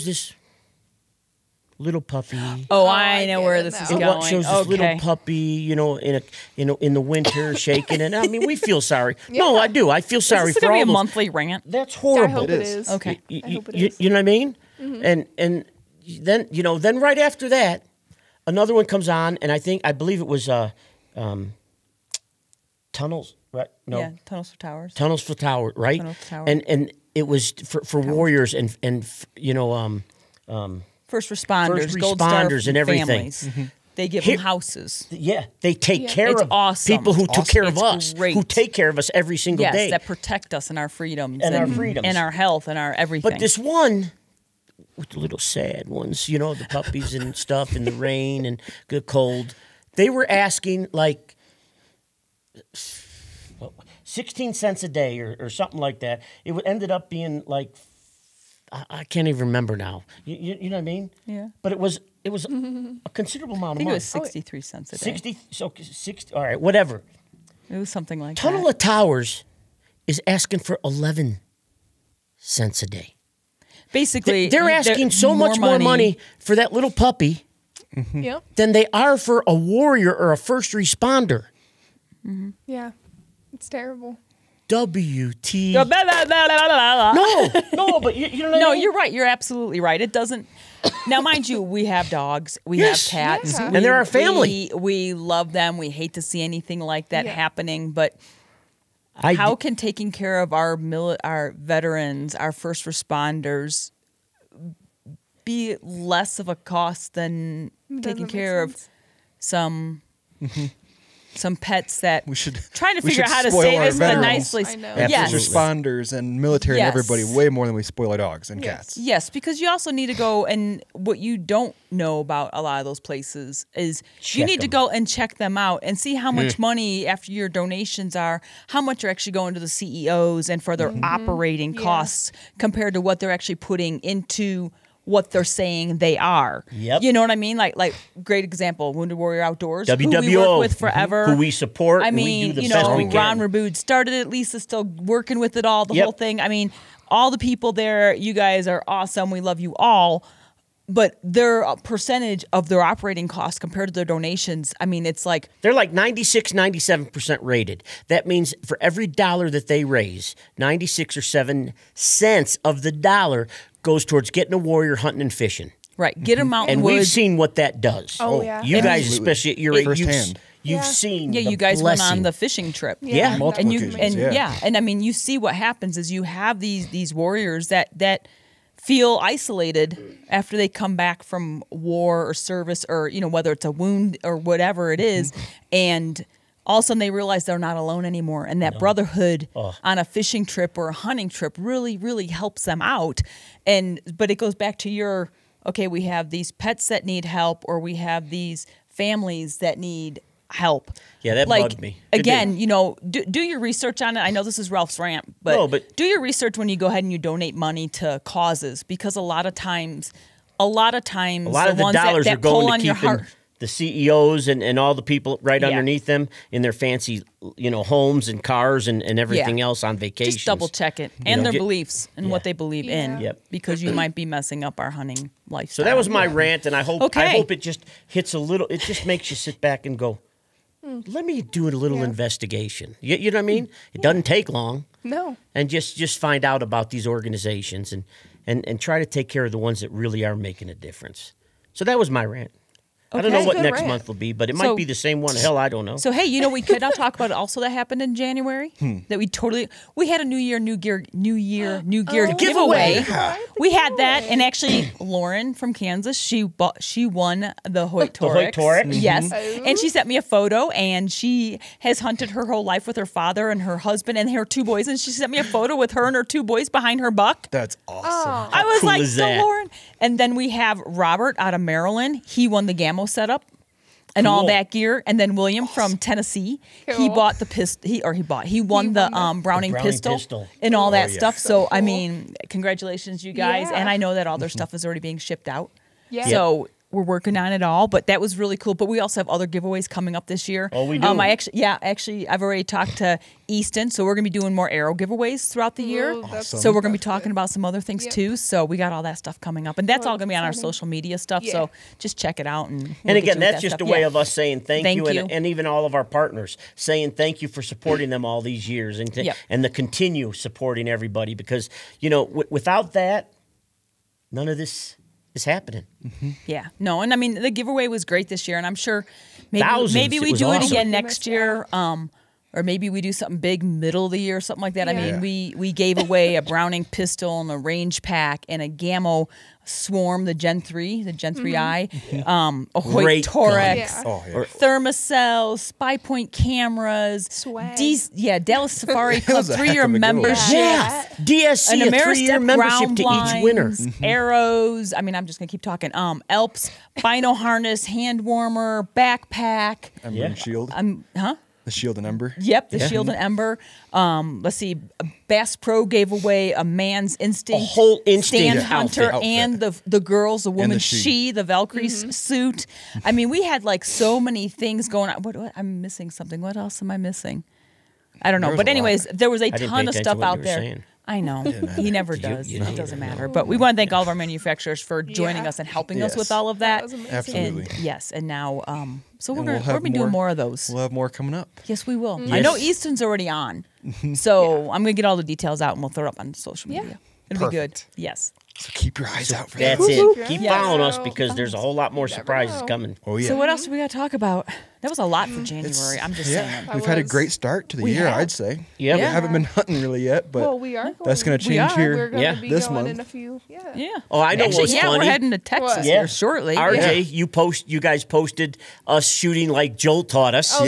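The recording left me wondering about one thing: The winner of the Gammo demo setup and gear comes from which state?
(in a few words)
Maryland.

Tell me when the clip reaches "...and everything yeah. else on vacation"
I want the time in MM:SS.
03:39.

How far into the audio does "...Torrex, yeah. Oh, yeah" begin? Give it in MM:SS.
05:33.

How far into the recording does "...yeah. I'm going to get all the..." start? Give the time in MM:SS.
06:24.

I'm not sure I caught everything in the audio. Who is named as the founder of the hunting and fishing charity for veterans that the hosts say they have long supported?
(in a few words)
Ron Rabud.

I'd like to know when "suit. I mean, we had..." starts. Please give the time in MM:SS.
06:02.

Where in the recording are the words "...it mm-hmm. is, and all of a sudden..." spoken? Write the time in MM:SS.
03:04.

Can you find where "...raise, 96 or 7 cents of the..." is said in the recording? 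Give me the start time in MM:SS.
02:39.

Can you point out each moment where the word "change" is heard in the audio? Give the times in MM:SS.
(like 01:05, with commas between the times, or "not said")
06:41.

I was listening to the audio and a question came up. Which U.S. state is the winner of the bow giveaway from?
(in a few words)
Kansas.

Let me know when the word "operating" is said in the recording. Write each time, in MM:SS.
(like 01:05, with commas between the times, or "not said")
02:11, 02:32.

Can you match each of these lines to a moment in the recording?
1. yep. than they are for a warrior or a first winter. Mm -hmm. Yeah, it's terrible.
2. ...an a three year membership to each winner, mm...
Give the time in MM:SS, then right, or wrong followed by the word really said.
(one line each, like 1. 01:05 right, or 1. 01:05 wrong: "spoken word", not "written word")
1. 01:18 wrong: "responder", not "winter"
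2. 05:41 right.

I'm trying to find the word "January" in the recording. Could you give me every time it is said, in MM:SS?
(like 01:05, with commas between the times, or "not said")
04:08, 06:35.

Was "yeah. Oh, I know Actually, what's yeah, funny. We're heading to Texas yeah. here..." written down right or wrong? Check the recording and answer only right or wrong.
right.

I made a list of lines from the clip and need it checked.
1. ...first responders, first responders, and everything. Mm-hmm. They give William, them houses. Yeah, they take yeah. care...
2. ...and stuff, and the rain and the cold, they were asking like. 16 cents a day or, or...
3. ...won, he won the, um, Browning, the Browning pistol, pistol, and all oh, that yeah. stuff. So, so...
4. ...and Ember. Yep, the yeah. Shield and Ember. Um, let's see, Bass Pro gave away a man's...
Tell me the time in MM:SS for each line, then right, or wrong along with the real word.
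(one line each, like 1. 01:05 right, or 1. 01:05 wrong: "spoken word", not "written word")
1. 00:31 wrong: "Here", not "William"
2. 00:47 right
3. 04:38 right
4. 05:51 right.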